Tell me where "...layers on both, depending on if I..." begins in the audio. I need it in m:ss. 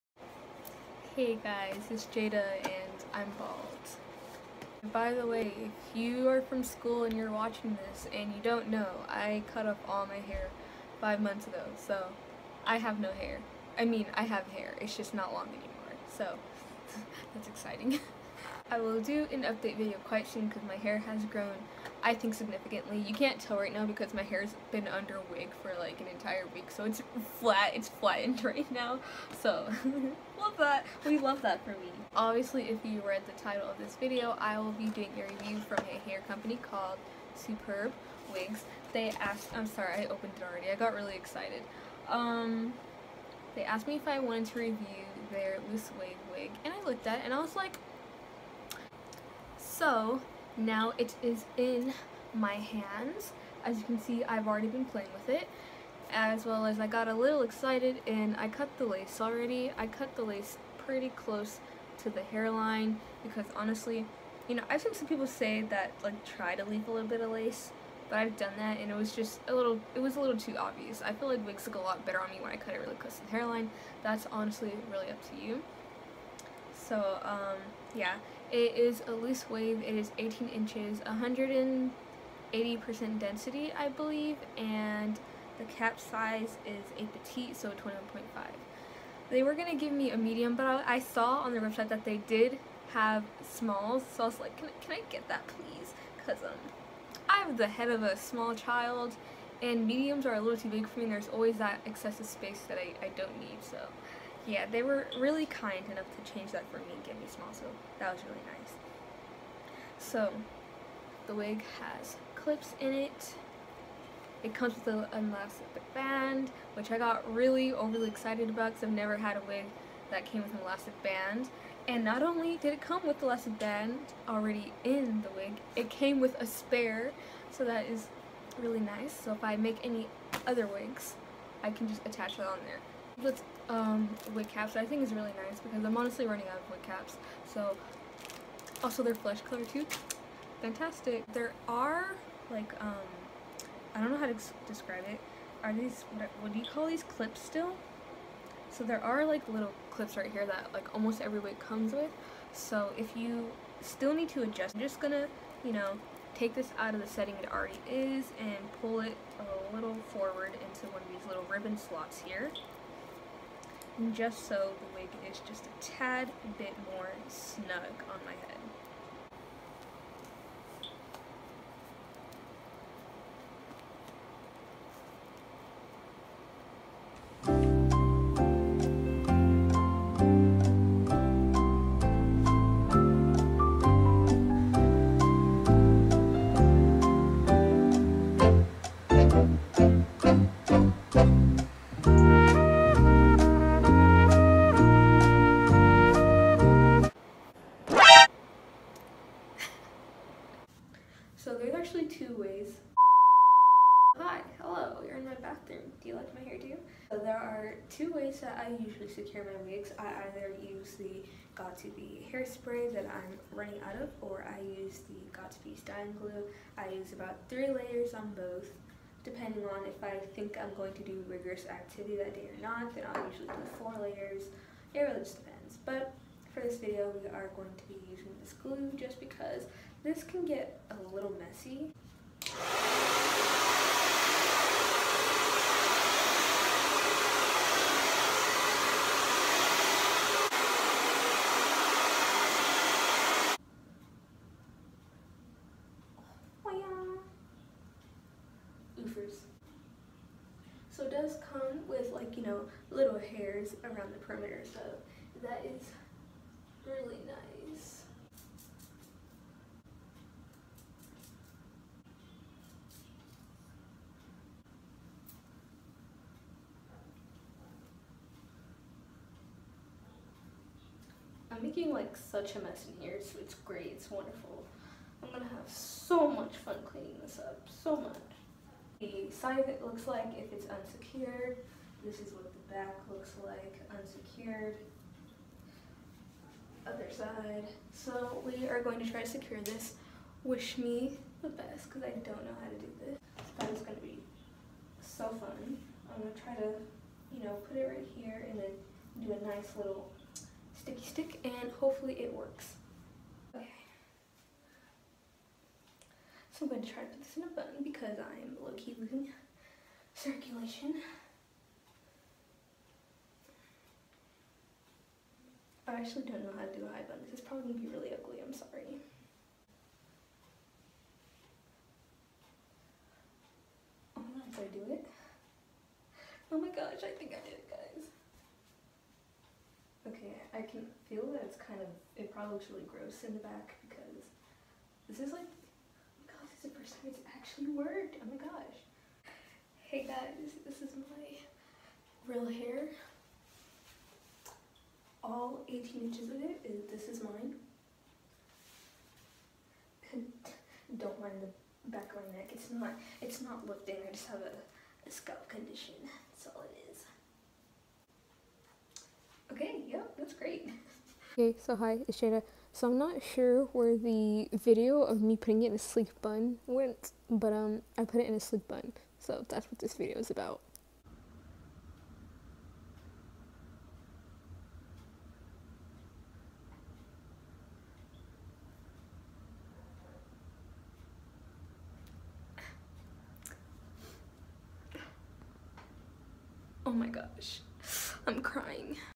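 3:37.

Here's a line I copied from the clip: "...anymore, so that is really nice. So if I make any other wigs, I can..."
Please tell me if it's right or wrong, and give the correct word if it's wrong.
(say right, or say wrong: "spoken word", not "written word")
wrong: "spare", not "anymore".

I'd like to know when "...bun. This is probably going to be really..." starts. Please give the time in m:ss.
5:17.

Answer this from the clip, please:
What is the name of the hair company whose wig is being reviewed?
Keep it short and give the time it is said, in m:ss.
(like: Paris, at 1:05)
Superb Wigs, at 0:37.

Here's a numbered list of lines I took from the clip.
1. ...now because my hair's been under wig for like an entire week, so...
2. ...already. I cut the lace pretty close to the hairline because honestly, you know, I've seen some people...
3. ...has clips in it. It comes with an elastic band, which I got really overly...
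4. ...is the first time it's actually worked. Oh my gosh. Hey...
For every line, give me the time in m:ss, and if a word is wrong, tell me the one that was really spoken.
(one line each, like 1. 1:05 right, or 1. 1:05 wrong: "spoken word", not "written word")
1. 0:23 right
2. 0:59 right
3. 1:51 right
4. 5:36 right.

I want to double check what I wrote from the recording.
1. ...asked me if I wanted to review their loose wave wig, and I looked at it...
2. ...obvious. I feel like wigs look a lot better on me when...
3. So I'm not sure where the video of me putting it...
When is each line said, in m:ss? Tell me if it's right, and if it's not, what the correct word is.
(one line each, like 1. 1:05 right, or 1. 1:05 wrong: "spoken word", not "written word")
1. 0:43 right
2. 1:10 right
3. 6:02 right.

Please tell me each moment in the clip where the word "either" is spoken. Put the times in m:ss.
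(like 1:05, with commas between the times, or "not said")
3:30.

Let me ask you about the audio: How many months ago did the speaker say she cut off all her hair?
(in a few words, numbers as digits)
5.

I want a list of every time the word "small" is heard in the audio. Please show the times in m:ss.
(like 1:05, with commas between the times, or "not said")
1:33, 1:38, 1:47.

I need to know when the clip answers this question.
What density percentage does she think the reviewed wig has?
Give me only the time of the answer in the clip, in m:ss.
1:20.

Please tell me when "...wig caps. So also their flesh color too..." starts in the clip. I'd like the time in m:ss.
2:16.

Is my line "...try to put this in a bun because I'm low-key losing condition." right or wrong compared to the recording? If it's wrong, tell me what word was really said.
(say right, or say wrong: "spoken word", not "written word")
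wrong: "circulation", not "condition".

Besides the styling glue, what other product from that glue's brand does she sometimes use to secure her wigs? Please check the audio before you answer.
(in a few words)
Got To Be hairspray.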